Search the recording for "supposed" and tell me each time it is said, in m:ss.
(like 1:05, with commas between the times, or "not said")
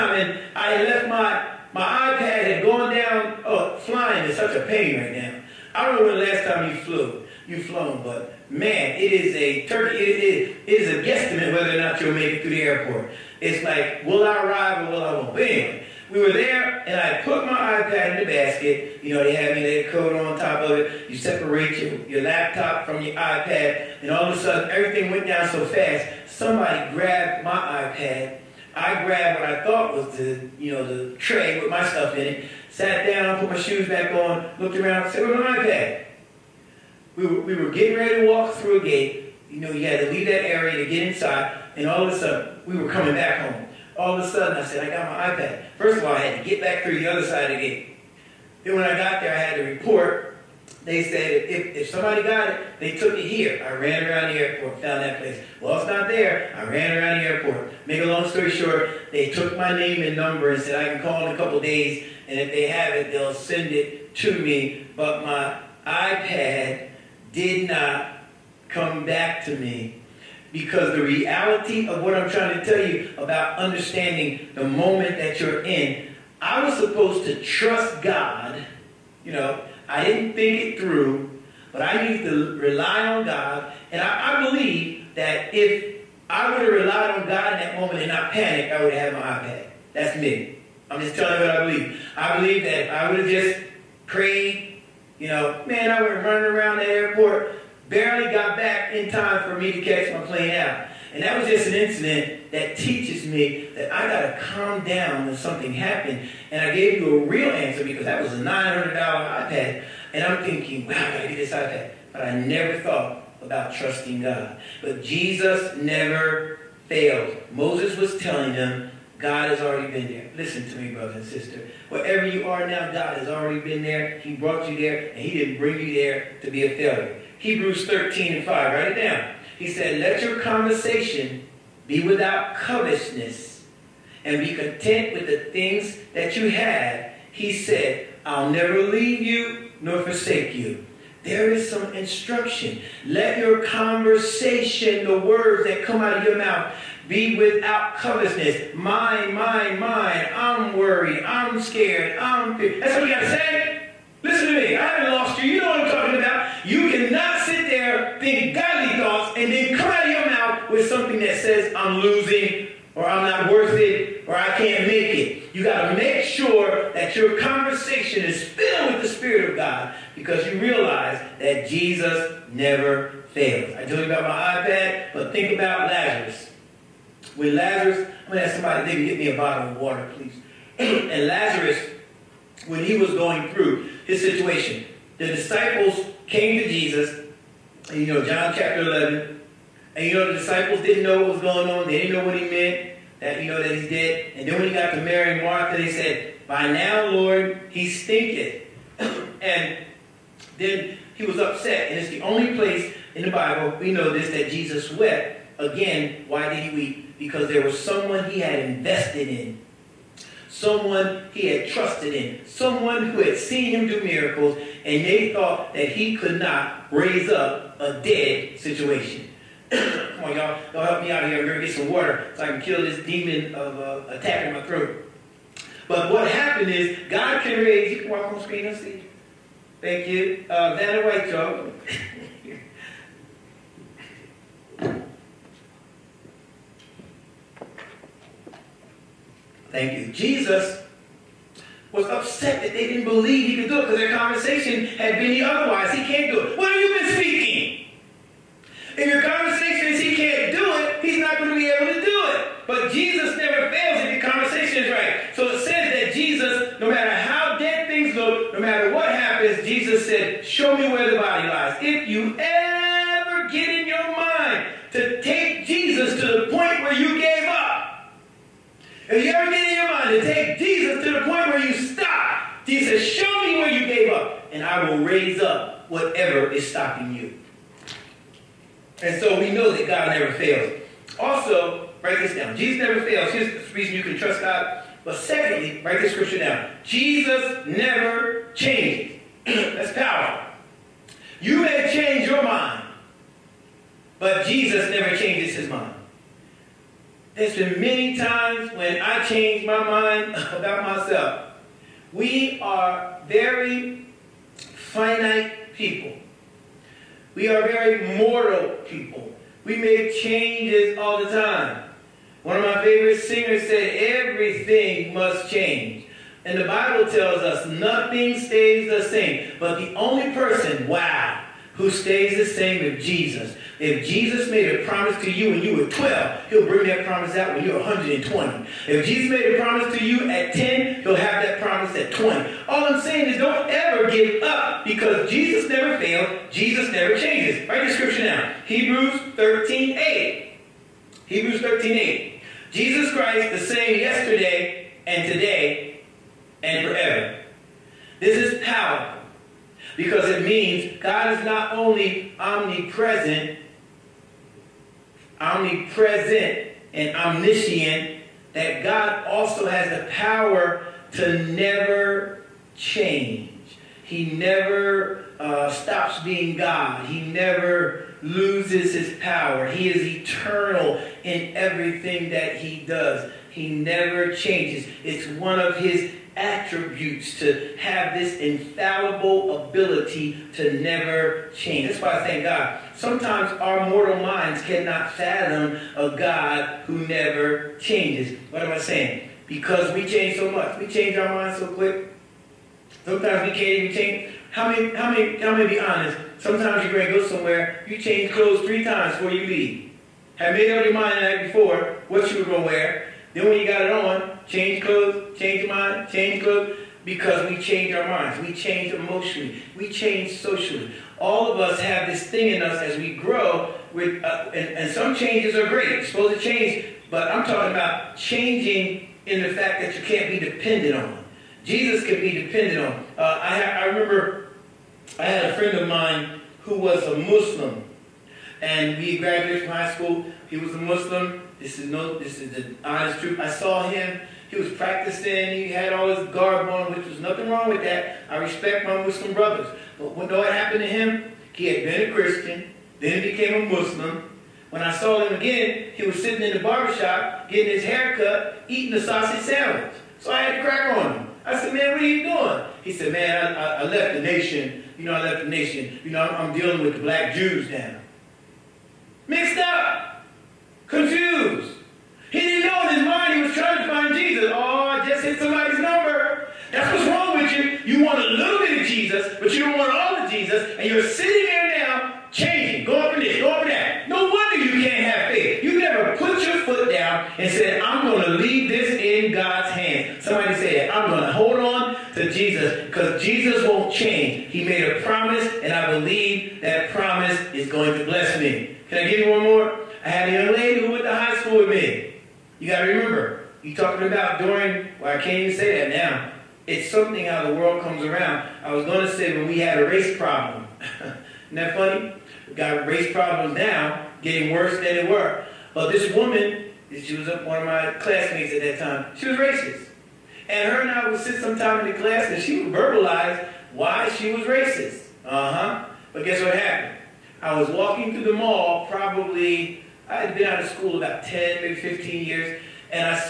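1:16, 6:56.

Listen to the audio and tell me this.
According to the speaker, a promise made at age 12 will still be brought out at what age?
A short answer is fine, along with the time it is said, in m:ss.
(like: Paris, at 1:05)
120, at 5:27.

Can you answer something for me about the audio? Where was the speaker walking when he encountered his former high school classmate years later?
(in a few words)
The mall.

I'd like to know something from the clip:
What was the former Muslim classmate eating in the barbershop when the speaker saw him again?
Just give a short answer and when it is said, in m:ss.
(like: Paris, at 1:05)
A sausage sandwich, at 7:29.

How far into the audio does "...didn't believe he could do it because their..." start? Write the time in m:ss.
4:02.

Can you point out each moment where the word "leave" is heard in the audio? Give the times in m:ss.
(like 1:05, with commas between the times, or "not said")
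0:40, 2:18, 6:39, 7:58.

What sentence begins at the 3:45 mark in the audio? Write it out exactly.
But what happened is God can raise.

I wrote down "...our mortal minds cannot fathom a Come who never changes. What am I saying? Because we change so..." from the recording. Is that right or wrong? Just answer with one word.
wrong.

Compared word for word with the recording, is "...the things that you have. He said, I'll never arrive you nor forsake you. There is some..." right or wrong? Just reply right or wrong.
wrong.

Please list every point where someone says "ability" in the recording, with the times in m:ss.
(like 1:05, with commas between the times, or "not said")
6:19.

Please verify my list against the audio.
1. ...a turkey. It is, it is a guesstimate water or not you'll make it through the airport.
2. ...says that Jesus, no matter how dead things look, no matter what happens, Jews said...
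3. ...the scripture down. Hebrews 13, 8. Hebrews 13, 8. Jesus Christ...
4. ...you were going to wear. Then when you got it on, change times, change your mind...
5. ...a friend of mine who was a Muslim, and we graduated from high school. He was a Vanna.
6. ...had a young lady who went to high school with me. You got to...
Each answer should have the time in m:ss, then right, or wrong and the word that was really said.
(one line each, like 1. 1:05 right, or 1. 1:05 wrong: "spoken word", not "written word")
1. 0:09 wrong: "whether", not "water"
2. 4:15 wrong: "Jesus", not "Jews"
3. 5:37 right
4. 6:42 wrong: "clothes", not "times"
5. 7:05 wrong: "Muslim", not "Vanna"
6. 8:10 right.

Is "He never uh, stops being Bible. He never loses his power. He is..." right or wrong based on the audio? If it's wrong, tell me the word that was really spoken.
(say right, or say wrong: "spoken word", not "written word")
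wrong: "God", not "Bible".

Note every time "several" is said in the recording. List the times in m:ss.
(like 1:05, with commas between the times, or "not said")
not said.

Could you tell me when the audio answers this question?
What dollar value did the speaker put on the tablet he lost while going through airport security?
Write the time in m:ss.
1:48.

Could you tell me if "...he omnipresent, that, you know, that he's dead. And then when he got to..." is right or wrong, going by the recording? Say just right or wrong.
wrong.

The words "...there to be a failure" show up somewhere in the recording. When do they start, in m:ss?
2:05.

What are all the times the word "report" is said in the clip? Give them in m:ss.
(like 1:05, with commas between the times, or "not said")
0:49.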